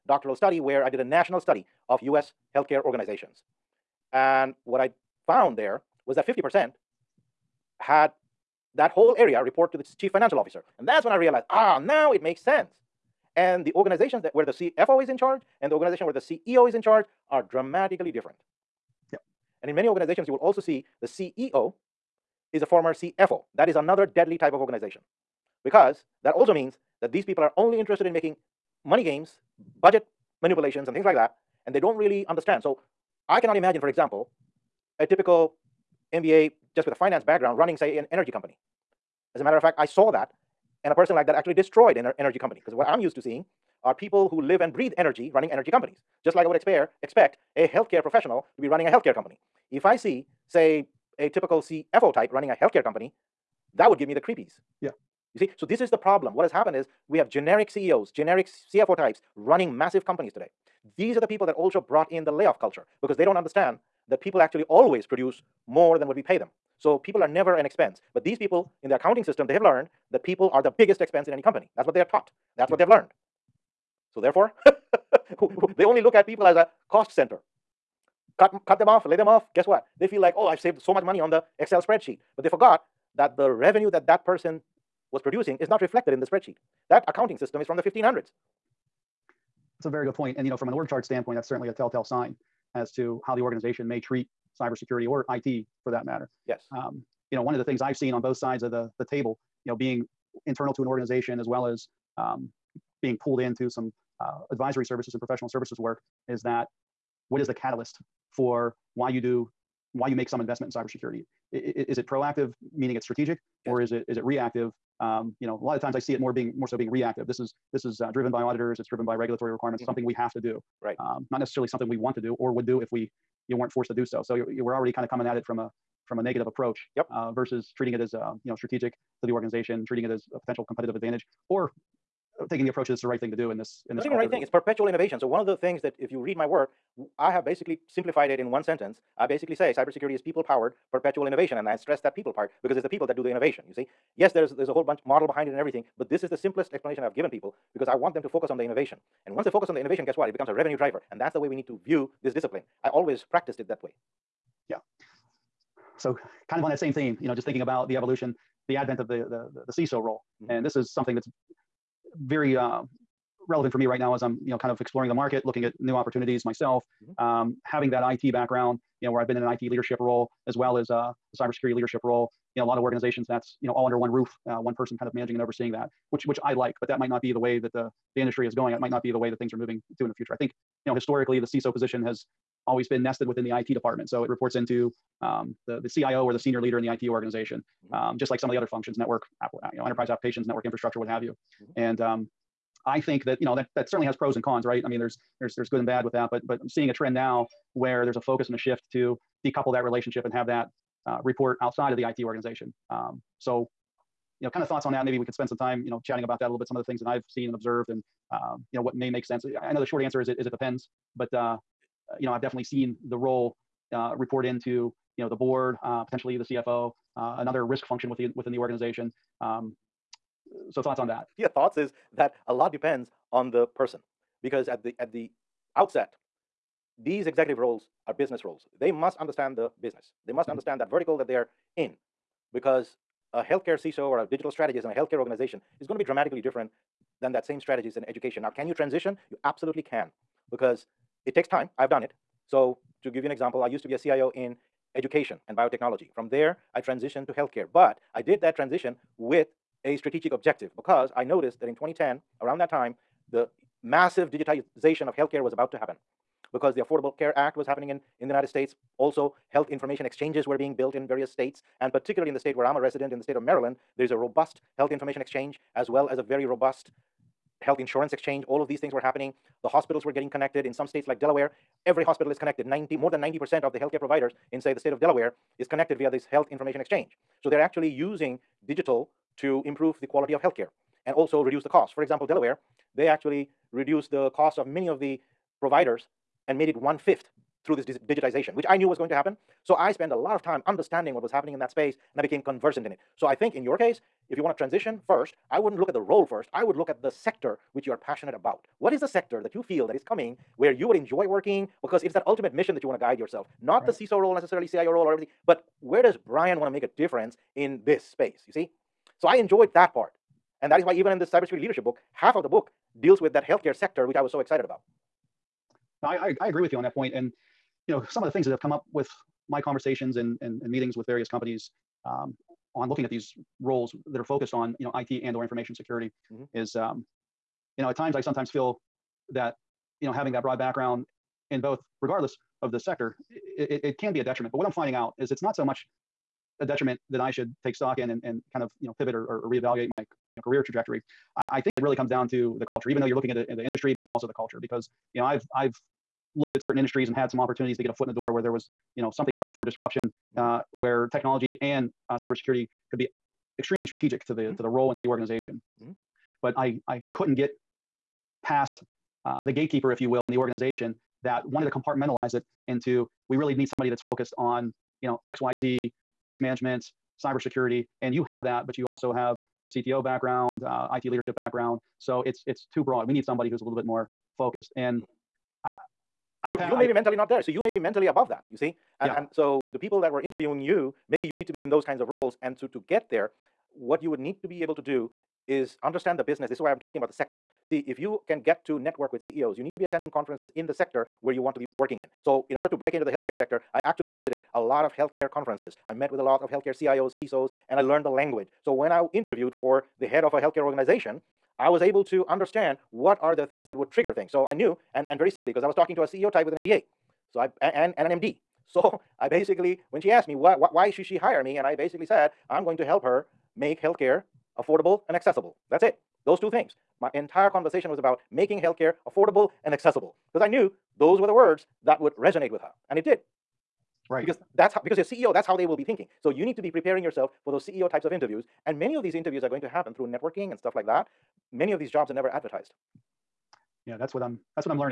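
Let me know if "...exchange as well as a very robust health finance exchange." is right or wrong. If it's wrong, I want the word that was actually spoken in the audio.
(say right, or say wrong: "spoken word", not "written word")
wrong: "insurance", not "finance".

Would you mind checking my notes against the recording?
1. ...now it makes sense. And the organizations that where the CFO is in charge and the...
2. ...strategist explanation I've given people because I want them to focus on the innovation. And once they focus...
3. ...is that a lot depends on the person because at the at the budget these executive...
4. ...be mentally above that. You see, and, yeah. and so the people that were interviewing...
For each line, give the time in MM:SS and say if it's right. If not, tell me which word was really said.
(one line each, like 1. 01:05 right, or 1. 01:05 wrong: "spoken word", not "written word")
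1. 00:11 right
2. 02:26 wrong: "simplest", not "strategist"
3. 03:41 wrong: "outset", not "budget"
4. 06:17 right.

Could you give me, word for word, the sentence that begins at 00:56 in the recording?
What has happened is we have generic CEOs, generic CFO types running massive companies today.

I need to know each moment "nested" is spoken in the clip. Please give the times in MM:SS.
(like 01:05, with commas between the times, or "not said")
03:03.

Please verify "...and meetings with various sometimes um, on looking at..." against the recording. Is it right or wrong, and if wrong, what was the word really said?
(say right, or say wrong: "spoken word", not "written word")
wrong: "companies", not "sometimes".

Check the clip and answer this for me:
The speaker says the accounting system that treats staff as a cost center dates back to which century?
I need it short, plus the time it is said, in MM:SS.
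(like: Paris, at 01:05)
1500s, at 01:27.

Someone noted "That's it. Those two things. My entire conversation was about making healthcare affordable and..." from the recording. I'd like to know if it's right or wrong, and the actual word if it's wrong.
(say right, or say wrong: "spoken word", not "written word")
right.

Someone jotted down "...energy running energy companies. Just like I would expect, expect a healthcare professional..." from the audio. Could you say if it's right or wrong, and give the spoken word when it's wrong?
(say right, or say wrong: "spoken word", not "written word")
right.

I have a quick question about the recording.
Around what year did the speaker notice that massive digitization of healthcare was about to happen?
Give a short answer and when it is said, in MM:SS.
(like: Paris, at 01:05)
2010, at 04:11.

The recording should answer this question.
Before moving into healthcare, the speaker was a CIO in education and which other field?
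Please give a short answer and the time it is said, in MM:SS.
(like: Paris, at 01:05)
biotechnology, at 04:05.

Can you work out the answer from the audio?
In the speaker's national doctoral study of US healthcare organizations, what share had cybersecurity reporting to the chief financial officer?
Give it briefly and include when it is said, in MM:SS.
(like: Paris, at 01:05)
50%, at 00:06.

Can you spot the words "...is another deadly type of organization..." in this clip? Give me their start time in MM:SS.
00:23.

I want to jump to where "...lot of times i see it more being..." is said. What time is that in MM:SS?
01:55.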